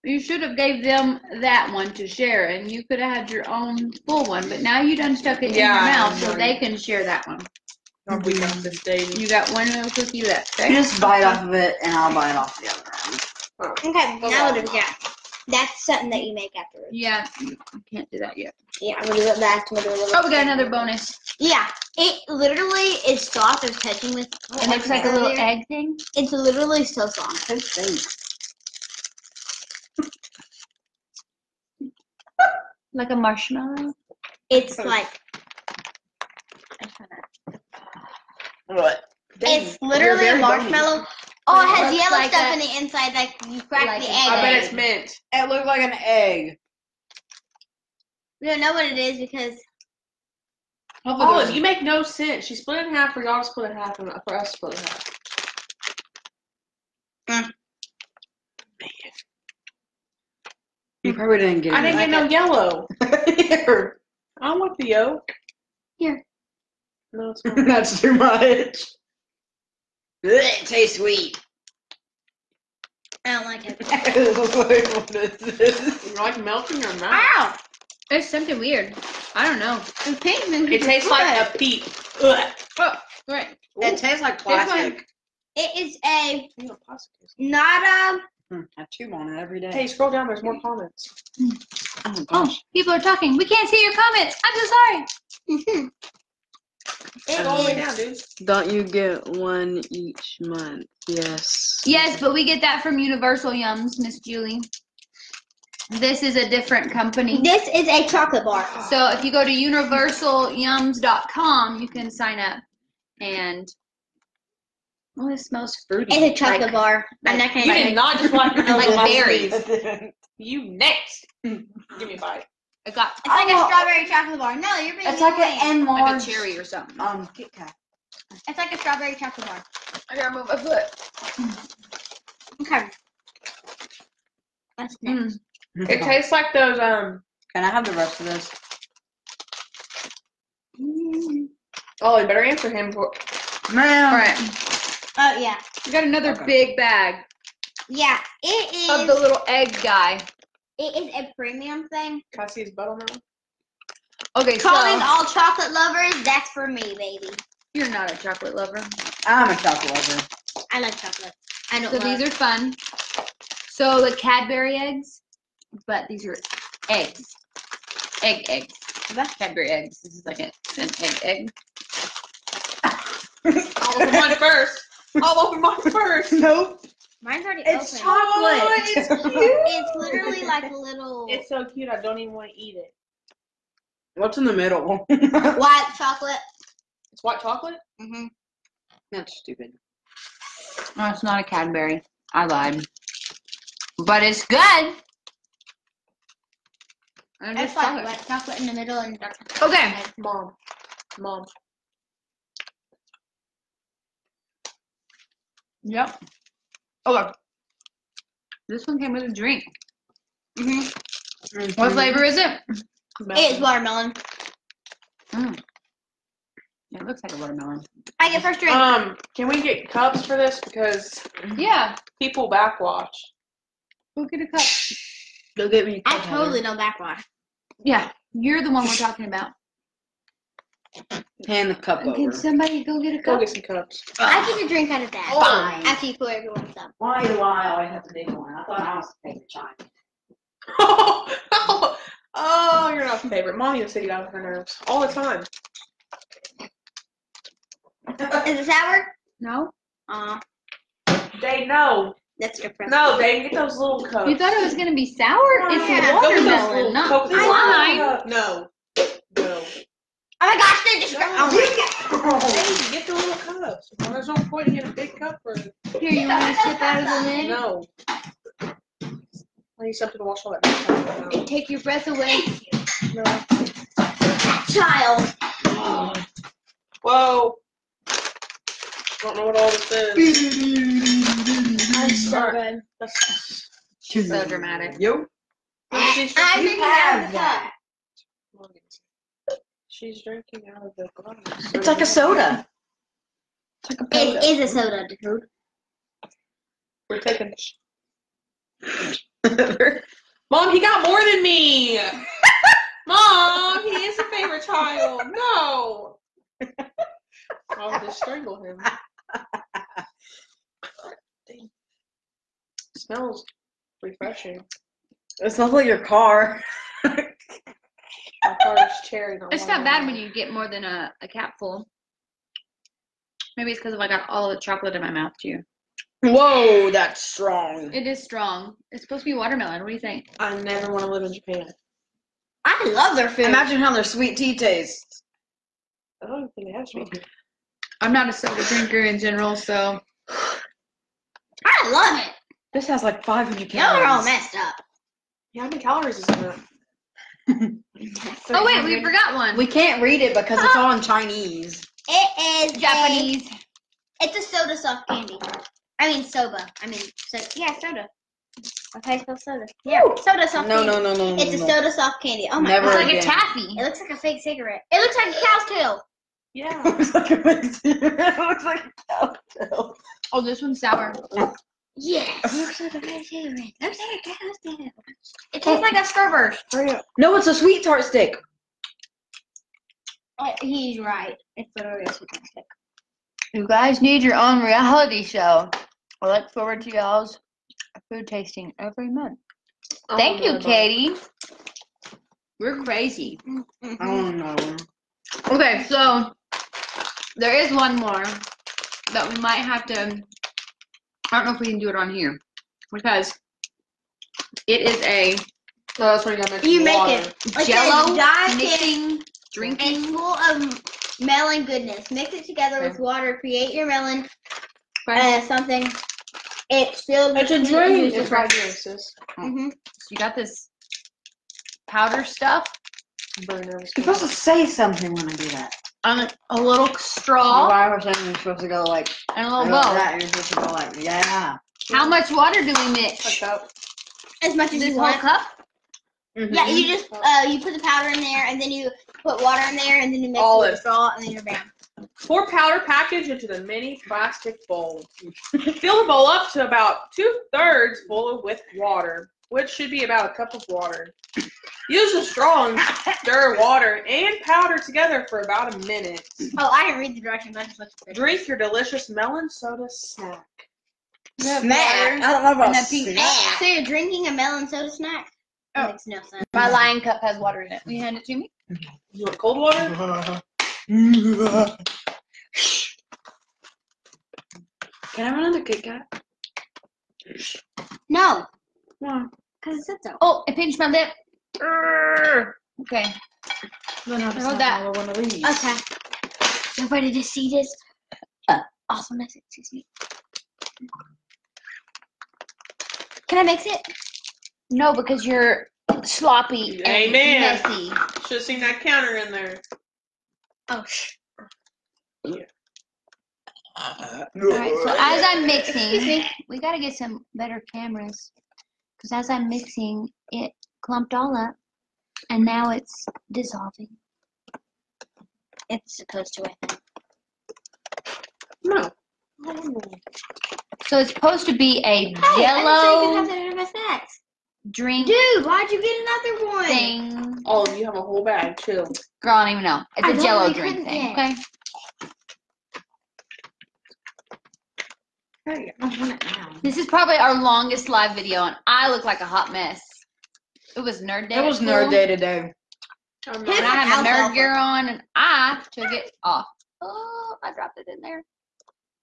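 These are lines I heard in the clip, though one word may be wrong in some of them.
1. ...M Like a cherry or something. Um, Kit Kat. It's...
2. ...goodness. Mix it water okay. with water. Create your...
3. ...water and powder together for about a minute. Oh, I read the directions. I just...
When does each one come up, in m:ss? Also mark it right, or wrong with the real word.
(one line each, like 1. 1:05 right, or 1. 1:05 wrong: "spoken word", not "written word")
1. 2:05 right
2. 6:51 wrong: "together", not "water"
3. 7:33 right.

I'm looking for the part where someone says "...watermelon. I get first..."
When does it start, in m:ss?
3:37.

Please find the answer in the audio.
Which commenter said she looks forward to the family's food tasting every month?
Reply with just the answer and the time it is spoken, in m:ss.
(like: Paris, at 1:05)
Katie, at 6:30.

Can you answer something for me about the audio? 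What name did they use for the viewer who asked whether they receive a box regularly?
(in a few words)
Miss Julie.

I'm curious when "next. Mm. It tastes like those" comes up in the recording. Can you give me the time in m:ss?
2:15.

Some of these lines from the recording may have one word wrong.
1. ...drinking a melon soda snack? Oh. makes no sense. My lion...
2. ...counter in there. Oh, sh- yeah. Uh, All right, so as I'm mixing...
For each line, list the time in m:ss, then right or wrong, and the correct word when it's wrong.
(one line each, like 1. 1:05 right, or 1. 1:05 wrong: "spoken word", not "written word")
1. 7:43 right
2. 8:18 right.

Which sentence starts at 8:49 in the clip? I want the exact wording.
It's I a jello drink thing, okay?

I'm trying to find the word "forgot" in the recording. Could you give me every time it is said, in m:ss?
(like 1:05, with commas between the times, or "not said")
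5:49.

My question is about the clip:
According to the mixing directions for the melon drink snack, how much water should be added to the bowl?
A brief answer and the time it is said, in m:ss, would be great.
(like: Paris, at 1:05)
About a cup, at 7:30.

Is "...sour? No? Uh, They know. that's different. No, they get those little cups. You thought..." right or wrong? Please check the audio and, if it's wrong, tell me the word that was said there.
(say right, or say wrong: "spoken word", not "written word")
right.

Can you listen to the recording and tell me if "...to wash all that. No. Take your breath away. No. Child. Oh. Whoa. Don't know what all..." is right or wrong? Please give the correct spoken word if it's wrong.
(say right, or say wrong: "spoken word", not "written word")
right.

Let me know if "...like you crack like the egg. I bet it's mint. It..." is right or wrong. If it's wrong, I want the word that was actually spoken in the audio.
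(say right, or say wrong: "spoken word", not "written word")
right.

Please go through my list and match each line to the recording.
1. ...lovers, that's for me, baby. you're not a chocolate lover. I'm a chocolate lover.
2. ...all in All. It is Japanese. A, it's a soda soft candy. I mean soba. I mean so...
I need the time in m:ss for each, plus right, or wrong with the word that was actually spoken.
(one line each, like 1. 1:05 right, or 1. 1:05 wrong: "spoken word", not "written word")
1. 2:35 right
2. 5:50 wrong: "Chinese", not "All".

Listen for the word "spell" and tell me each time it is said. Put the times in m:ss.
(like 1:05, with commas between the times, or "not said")
5:59.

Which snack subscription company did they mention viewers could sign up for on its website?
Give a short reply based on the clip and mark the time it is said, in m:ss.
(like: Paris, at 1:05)
Universal Yums, at 1:42.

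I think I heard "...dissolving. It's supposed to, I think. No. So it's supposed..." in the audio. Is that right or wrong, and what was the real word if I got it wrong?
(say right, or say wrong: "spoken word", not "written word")
right.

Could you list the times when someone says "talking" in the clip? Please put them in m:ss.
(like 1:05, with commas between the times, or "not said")
1:32, 3:48.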